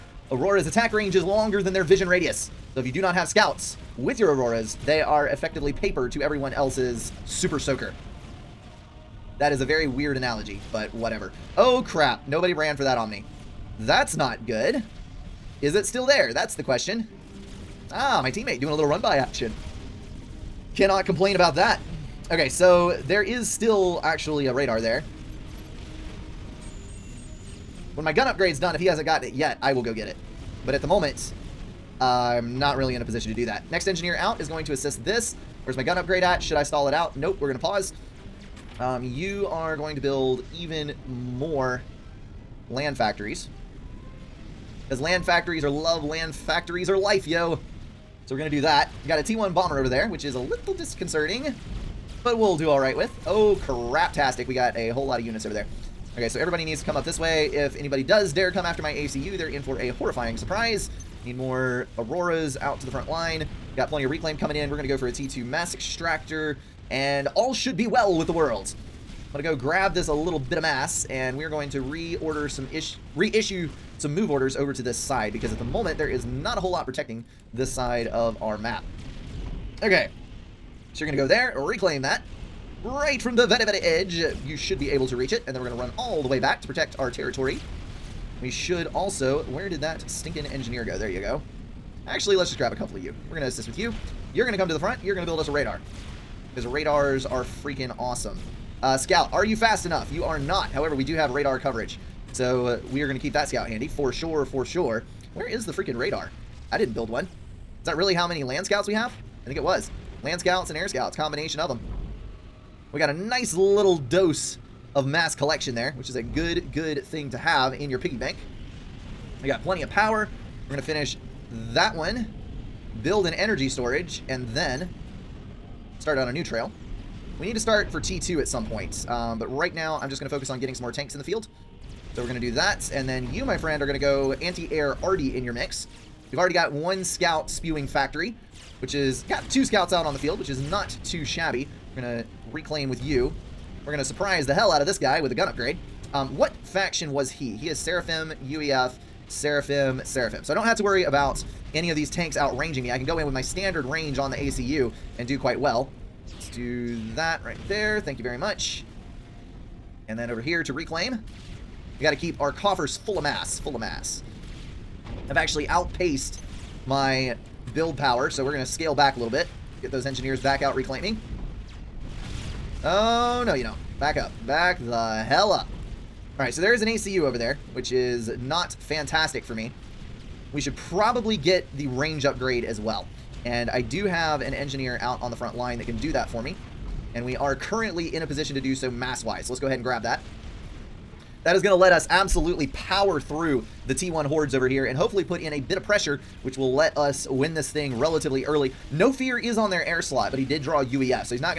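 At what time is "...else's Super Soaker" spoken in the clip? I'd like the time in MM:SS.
00:06.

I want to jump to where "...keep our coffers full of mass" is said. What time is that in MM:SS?
02:42.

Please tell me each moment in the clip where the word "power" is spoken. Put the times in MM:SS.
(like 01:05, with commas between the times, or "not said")
01:59, 02:47, 03:12.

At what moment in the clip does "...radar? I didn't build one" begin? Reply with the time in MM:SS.
01:45.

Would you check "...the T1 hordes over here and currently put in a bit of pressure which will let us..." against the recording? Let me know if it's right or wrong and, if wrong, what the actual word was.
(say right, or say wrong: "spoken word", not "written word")
wrong: "hopefully", not "currently".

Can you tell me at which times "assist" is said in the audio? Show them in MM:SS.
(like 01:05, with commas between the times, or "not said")
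00:34, 01:33.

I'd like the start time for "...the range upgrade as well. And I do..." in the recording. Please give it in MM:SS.
03:01.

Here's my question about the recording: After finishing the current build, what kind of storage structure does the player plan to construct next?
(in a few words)
energy storage.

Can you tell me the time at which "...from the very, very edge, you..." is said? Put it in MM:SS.
01:23.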